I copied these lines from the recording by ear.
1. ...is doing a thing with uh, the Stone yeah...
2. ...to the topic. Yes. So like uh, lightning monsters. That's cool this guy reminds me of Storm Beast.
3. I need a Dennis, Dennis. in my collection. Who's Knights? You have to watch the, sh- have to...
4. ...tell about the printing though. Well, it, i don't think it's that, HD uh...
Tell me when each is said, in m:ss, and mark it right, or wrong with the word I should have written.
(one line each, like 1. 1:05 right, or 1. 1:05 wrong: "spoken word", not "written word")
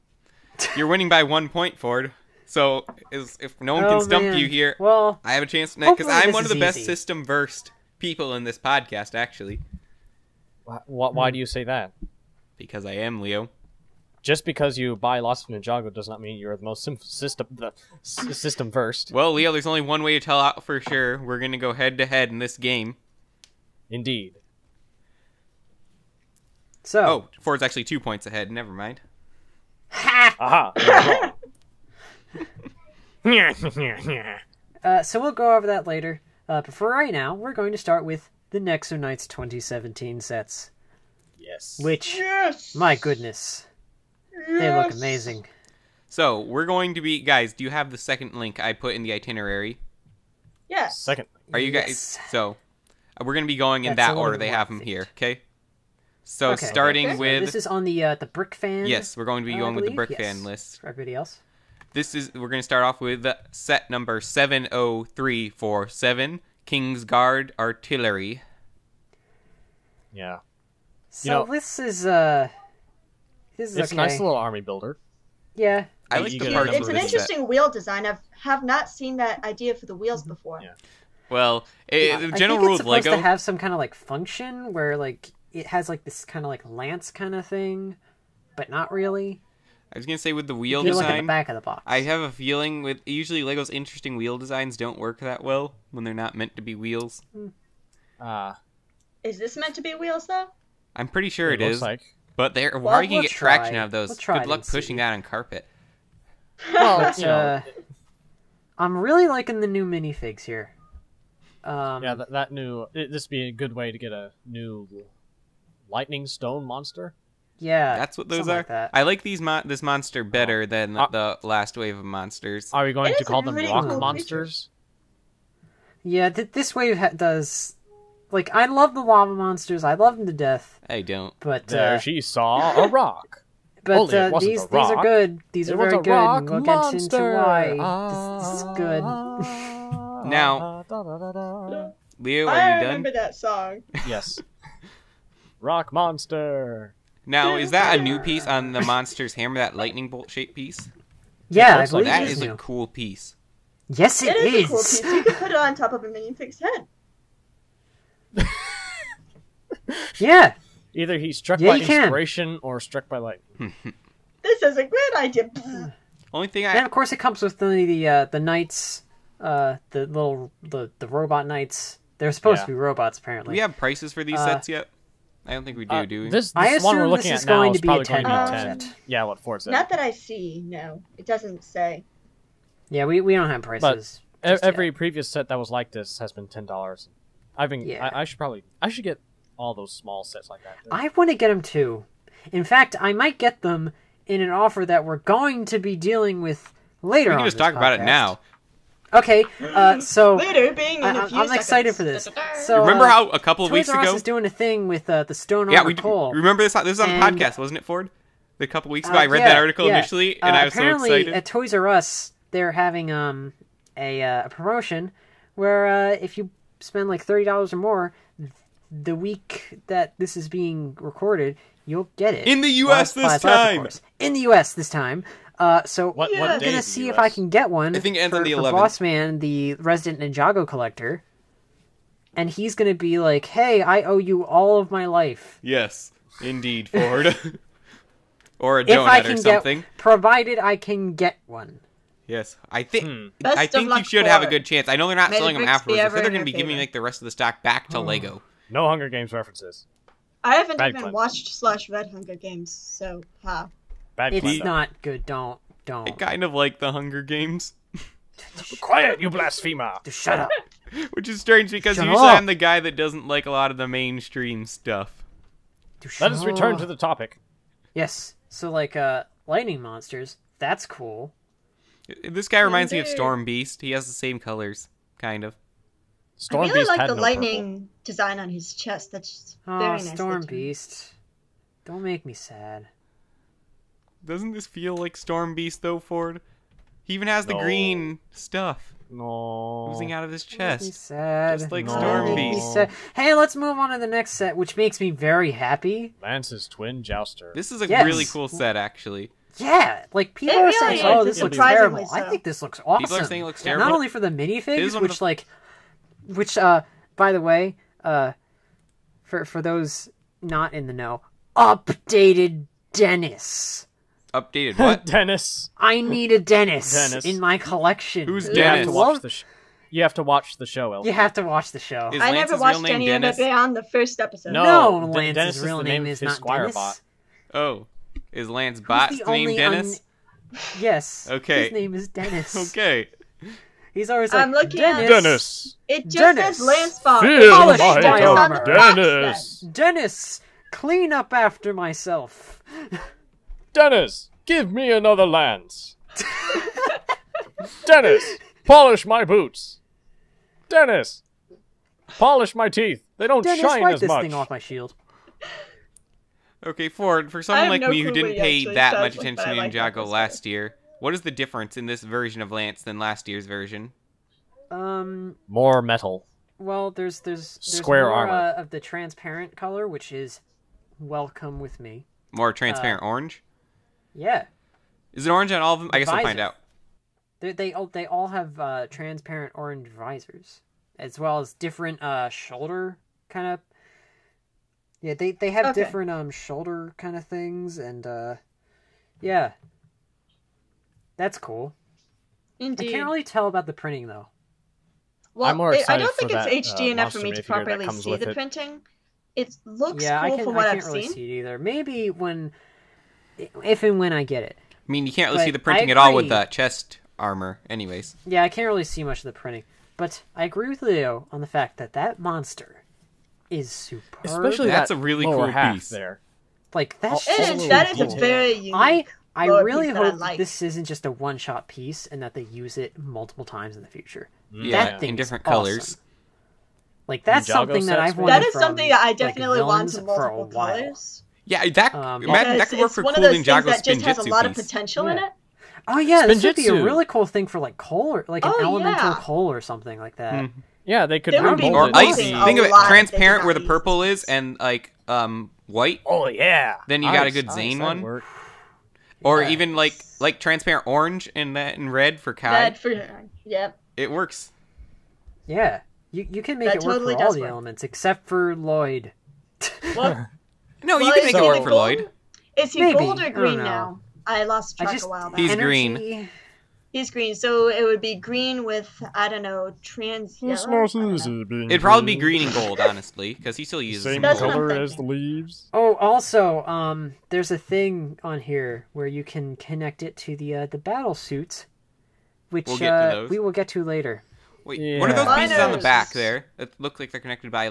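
1. 3:24 right
2. 4:26 right
3. 5:15 wrong: "Dennis", not "Knights"
4. 6:33 right.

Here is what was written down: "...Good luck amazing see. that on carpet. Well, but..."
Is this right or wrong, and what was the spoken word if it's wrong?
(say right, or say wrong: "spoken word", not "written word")
wrong: "pushing", not "amazing".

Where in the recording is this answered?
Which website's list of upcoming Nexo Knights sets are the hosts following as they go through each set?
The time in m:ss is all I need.
0:58.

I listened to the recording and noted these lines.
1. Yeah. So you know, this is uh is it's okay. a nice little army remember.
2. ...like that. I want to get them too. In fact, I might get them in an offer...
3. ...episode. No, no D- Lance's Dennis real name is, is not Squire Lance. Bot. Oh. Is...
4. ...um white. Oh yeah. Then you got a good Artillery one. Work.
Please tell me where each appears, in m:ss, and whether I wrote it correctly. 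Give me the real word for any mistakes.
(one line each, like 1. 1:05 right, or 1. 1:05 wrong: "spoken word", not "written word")
1. 1:10 wrong: "builder", not "remember"
2. 3:10 right
3. 5:24 wrong: "Dennis", not "Lance"
4. 7:25 wrong: "Zane", not "Artillery".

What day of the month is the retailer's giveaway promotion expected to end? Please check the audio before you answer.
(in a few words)
the 11th.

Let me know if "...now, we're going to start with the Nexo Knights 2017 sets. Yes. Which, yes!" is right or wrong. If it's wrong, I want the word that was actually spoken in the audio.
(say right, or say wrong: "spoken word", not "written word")
right.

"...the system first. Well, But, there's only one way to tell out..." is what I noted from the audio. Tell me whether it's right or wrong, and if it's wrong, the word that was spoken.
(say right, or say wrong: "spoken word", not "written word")
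wrong: "Leo", not "But".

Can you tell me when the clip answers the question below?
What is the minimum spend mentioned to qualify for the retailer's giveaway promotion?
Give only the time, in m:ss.
3:37.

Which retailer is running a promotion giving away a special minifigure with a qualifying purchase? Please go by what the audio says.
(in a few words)
Toys R Us.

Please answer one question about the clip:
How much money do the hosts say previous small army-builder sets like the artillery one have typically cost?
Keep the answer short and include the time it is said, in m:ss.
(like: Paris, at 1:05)
10 dollars, at 3:06.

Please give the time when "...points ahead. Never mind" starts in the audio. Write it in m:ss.
0:27.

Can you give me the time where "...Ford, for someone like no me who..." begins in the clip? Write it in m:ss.
5:56.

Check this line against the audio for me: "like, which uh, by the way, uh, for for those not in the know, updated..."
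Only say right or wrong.
right.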